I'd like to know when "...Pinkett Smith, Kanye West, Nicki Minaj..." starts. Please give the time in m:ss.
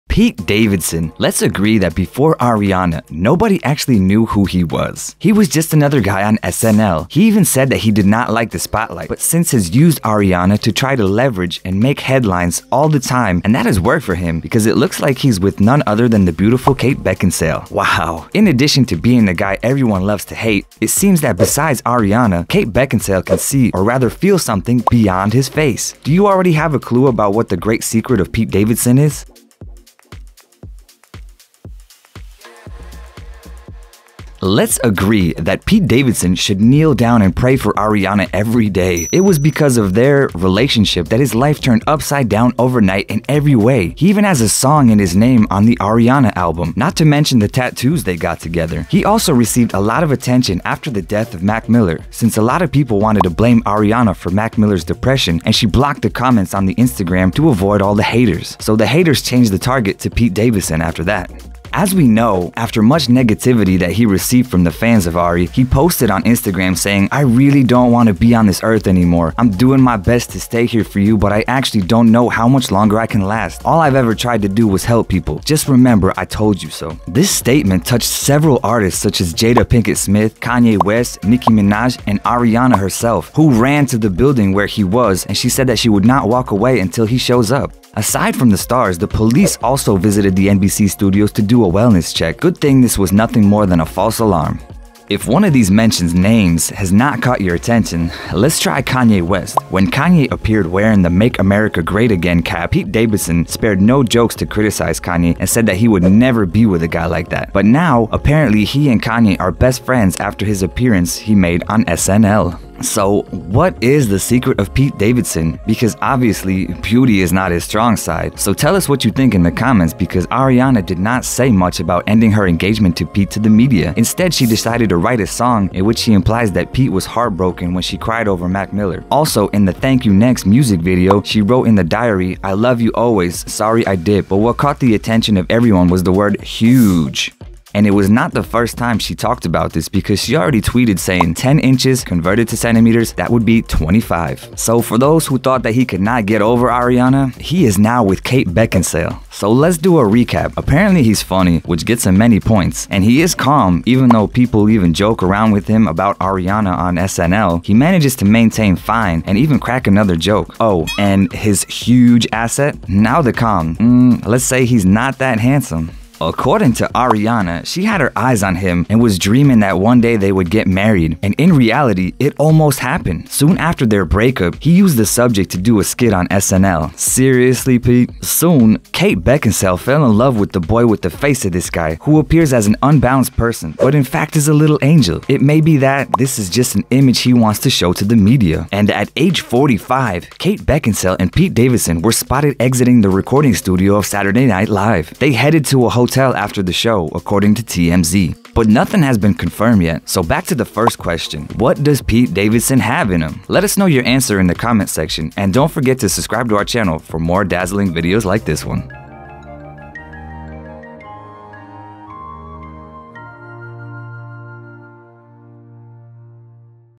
1:19.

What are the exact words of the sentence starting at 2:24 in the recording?
So for those who thought that he could not get over Ariana, he is now with Kate Beckinsale.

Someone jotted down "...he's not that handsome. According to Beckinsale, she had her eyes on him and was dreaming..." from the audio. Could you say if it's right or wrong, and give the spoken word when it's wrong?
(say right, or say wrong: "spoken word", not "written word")
wrong: "Ariana", not "Beckinsale".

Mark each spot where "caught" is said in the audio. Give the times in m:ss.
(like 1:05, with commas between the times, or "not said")
1:37, 2:14.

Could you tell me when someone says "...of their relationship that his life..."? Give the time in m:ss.
0:39.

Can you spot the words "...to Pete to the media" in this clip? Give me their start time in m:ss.
2:02.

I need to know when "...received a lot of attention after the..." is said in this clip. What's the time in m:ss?
0:49.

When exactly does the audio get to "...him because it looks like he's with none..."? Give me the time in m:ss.
0:14.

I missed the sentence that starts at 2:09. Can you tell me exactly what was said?
Also, in the Thank You Next music video, she wrote in the diary, I love you always, sorry I did.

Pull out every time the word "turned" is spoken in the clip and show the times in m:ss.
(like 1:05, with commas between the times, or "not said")
0:41.